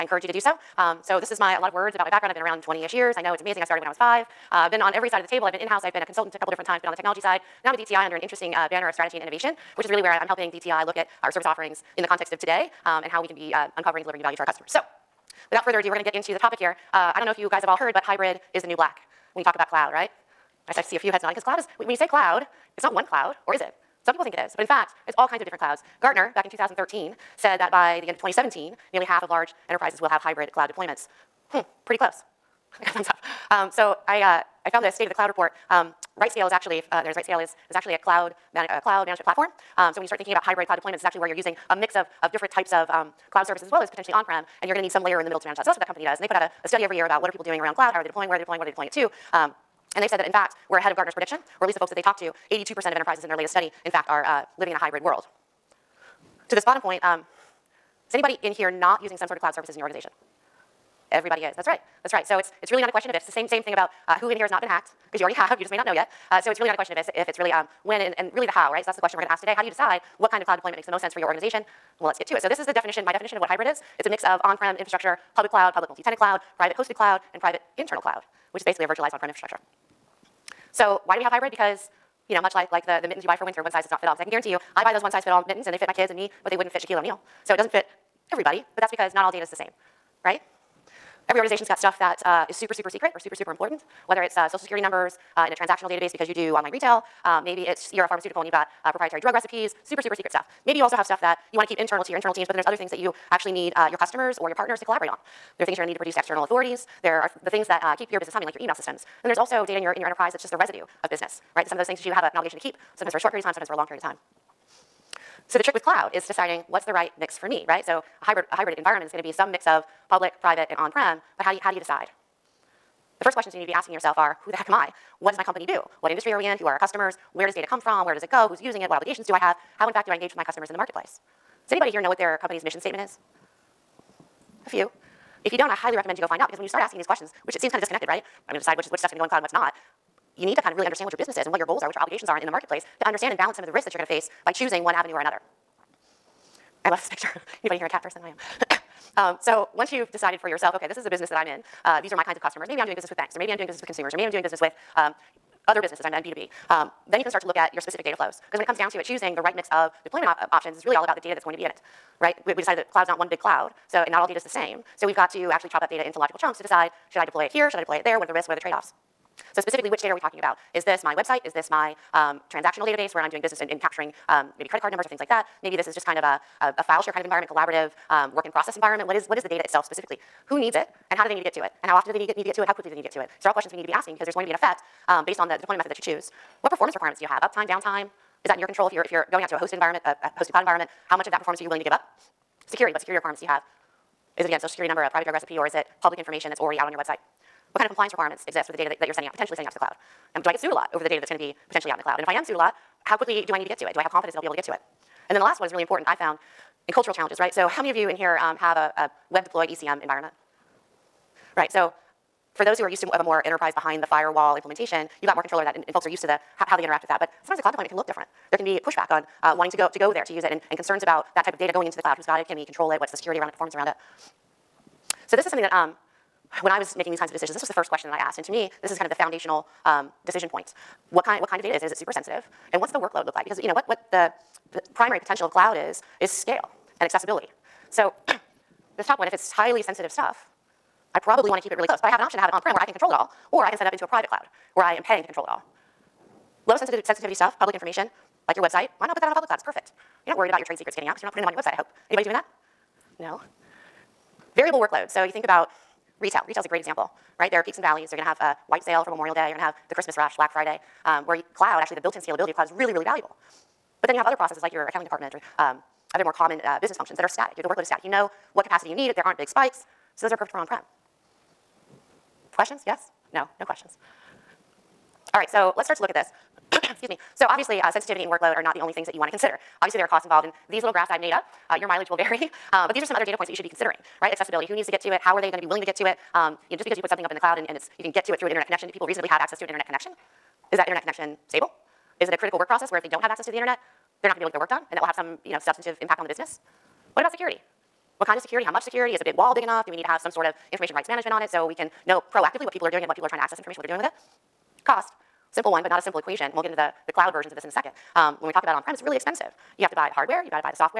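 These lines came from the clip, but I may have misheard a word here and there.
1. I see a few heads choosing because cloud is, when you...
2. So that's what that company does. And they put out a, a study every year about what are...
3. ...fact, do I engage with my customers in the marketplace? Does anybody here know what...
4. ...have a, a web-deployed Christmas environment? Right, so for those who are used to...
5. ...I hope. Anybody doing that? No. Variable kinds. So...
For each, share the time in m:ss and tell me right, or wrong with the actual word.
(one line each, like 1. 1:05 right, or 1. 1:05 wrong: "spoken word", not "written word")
1. 0:20 wrong: "nodding", not "choosing"
2. 0:45 right
3. 2:09 right
4. 3:28 wrong: "ECM", not "Christmas"
5. 4:11 wrong: "workloads", not "kinds".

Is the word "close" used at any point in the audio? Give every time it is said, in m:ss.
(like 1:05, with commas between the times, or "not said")
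0:31, 4:01.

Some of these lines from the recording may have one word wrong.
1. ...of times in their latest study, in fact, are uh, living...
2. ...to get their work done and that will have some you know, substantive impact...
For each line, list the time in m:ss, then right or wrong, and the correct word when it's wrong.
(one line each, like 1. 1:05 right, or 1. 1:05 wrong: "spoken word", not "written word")
1. 0:52 wrong: "enterprises", not "times"
2. 4:54 right.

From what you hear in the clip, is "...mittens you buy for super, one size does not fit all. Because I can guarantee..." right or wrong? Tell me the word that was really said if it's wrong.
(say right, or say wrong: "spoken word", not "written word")
wrong: "winter", not "super".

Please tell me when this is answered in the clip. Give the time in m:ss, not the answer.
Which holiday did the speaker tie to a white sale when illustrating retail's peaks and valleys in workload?
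4:19.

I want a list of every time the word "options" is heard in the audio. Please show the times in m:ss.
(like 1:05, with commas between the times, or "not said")
2:40, 4:02.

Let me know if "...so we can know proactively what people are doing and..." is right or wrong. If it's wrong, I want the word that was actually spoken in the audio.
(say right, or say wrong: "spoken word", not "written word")
right.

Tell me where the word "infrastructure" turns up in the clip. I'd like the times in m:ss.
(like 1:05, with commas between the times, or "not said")
1:14, 1:19.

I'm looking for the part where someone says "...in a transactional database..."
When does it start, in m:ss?
1:35.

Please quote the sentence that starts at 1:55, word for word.
So the trick with cloud is deciding what's the right mix for me, right?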